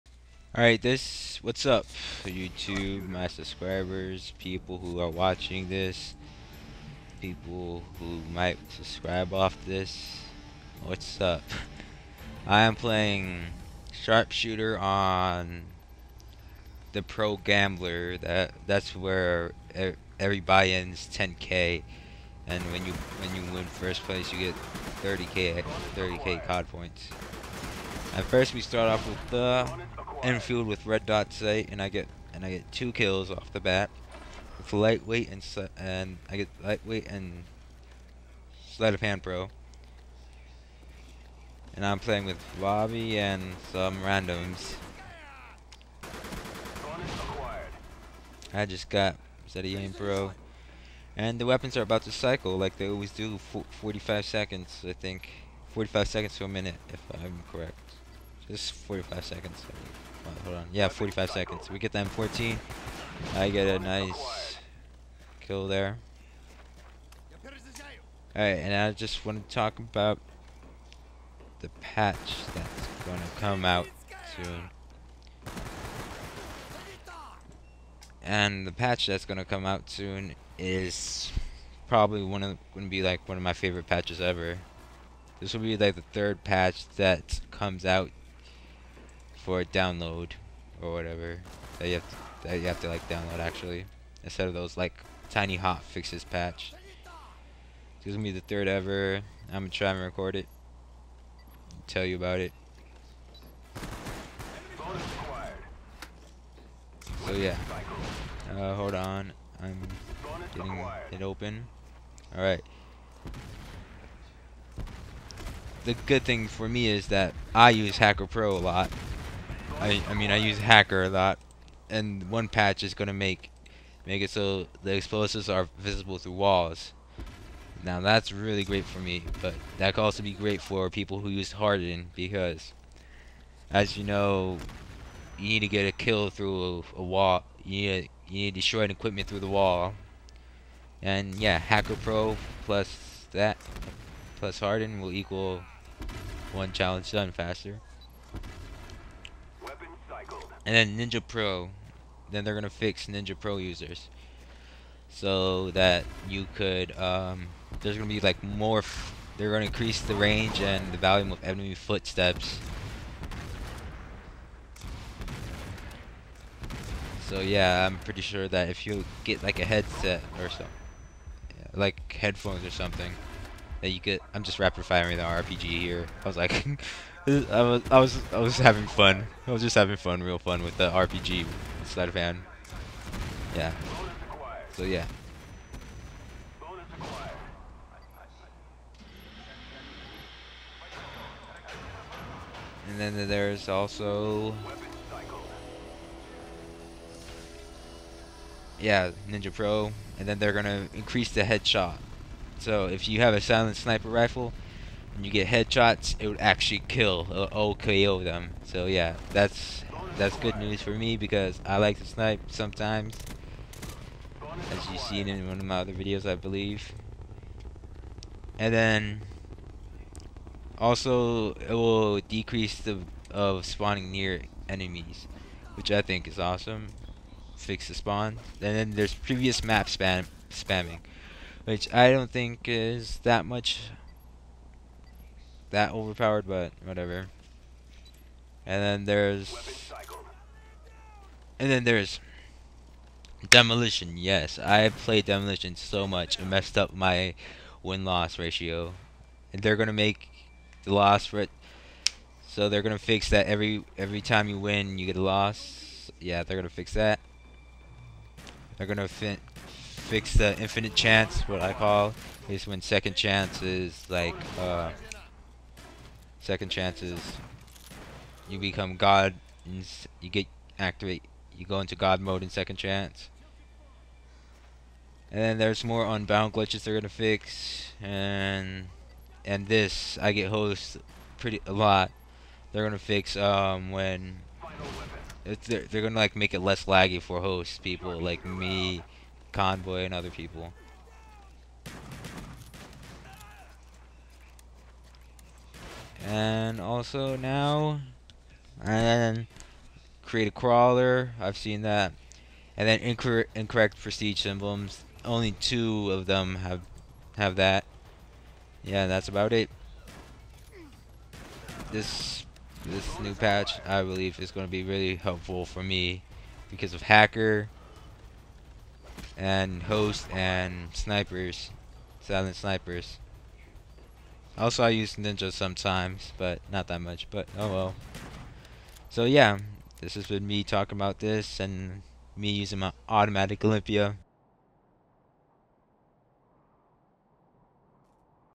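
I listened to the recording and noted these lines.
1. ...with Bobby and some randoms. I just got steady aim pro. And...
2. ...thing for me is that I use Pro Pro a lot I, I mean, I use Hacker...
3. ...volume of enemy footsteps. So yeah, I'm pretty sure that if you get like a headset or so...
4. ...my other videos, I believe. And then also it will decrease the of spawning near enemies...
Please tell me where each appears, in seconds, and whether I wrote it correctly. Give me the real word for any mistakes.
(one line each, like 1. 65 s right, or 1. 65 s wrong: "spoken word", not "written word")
1. 42 s right
2. 116 s wrong: "Hacker", not "Pro"
3. 160 s right
4. 215 s right.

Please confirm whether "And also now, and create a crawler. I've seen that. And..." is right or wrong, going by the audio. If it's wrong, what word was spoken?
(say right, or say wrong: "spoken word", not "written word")
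right.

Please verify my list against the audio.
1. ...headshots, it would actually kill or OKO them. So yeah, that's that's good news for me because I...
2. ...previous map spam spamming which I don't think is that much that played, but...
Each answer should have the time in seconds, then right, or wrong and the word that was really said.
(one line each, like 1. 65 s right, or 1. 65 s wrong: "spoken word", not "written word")
1. 205 s right
2. 229 s wrong: "overpowered", not "played".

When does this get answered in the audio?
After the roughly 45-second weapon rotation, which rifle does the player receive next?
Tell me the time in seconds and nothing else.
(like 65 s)
61 s.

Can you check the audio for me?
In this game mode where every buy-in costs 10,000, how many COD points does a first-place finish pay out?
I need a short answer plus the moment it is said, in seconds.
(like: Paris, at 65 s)
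30k, at 25 s.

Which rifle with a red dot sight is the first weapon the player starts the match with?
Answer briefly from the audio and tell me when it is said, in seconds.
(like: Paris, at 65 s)
Enfield, at 30 s.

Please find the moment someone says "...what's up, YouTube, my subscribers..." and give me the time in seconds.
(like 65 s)
1 s.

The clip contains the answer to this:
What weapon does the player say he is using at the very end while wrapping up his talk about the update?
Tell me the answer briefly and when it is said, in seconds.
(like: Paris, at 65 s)
Olympia, at 333 s.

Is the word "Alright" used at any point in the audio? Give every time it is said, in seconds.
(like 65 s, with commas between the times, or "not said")
0 s, 68 s, 112 s.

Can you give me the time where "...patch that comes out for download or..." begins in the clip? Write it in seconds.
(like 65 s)
86 s.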